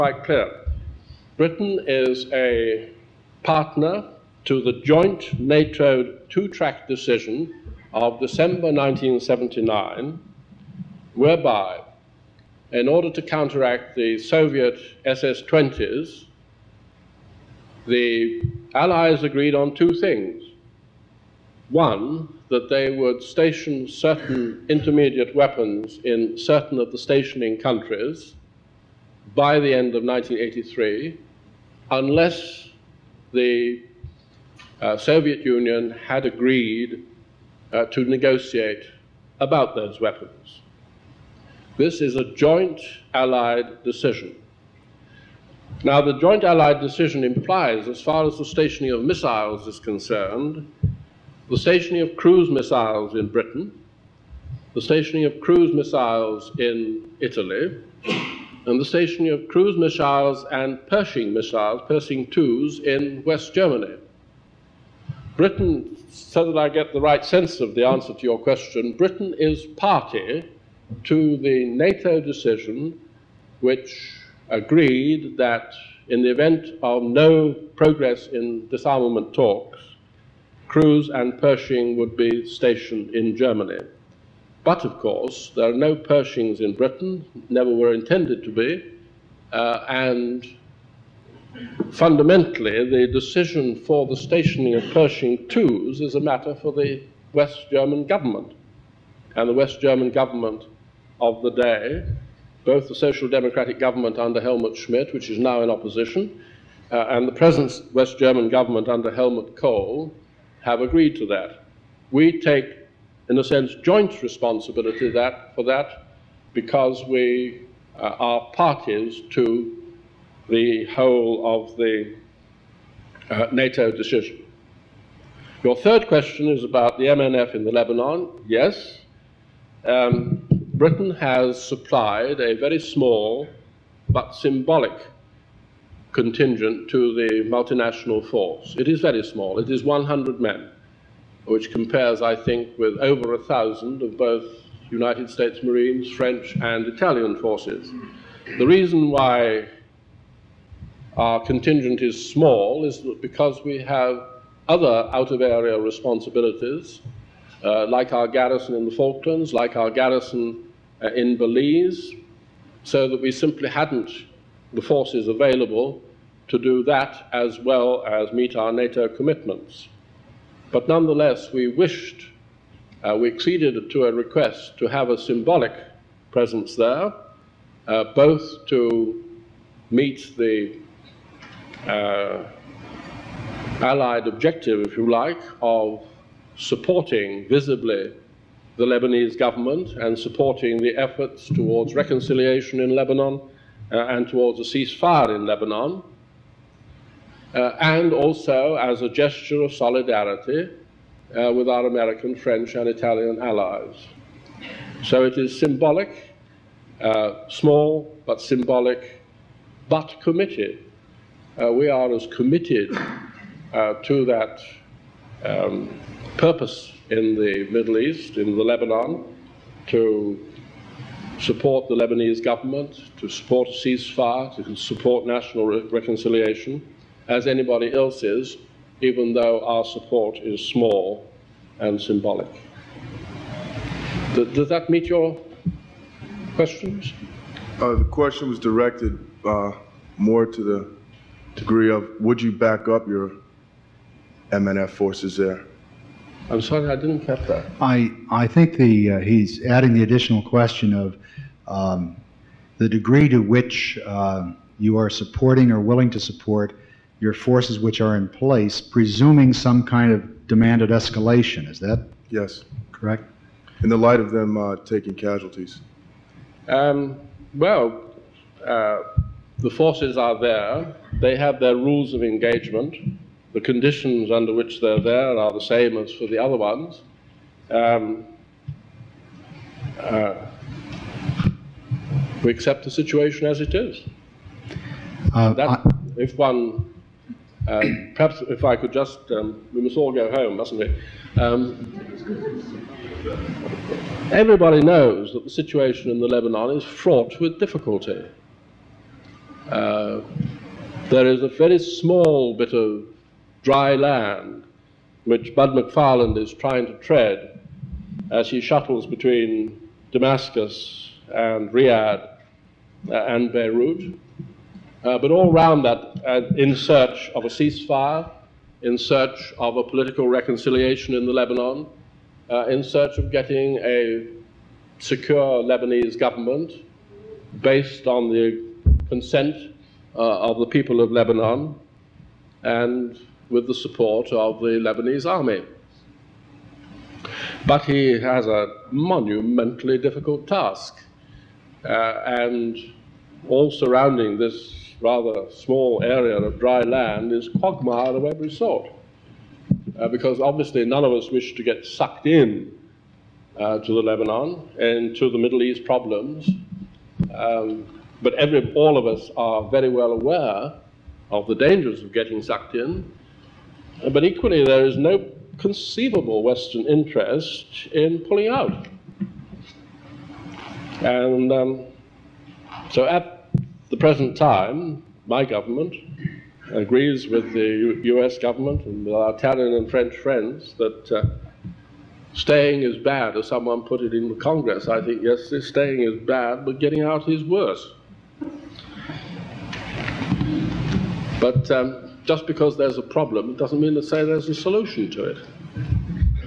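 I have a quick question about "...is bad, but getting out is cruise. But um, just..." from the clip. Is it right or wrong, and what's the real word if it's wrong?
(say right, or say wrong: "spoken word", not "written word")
wrong: "worse", not "cruise".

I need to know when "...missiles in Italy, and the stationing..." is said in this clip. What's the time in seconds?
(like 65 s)
55 s.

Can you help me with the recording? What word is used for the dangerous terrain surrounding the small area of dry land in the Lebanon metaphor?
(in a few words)
quagmire.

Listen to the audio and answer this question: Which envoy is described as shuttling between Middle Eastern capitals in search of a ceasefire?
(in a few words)
Bud McFarlane.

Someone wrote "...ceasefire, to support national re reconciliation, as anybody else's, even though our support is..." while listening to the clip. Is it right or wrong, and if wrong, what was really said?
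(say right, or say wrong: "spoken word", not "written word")
right.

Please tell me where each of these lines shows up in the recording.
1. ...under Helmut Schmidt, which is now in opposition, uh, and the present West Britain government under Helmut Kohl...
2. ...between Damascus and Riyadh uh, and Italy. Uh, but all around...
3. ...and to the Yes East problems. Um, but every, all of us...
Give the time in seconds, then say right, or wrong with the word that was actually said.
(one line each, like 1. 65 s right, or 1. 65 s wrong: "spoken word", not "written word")
1. 104 s wrong: "German", not "Britain"
2. 309 s wrong: "Beirut", not "Italy"
3. 354 s wrong: "Middle", not "Yes".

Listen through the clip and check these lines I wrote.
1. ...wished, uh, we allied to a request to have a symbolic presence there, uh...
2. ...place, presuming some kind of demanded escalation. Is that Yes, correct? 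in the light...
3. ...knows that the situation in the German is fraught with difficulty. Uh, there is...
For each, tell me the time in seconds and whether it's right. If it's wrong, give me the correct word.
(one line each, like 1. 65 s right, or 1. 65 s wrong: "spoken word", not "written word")
1. 171 s wrong: "acceded", not "allied"
2. 258 s right
3. 294 s wrong: "Lebanon", not "German".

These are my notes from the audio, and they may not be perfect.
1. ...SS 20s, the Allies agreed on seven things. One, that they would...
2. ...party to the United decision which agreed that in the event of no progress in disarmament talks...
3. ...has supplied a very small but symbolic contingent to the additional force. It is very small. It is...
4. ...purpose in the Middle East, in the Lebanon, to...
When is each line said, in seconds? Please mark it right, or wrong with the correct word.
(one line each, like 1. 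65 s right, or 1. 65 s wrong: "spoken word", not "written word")
1. 15 s wrong: "two", not "seven"
2. 69 s wrong: "NATO", not "United"
3. 131 s wrong: "multinational", not "additional"
4. 216 s right.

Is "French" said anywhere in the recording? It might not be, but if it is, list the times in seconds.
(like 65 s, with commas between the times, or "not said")
146 s, 202 s, 379 s.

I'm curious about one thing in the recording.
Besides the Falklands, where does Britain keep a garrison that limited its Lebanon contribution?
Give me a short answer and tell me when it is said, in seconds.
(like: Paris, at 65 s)
Belize, at 161 s.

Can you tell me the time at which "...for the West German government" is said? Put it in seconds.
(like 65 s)
96 s.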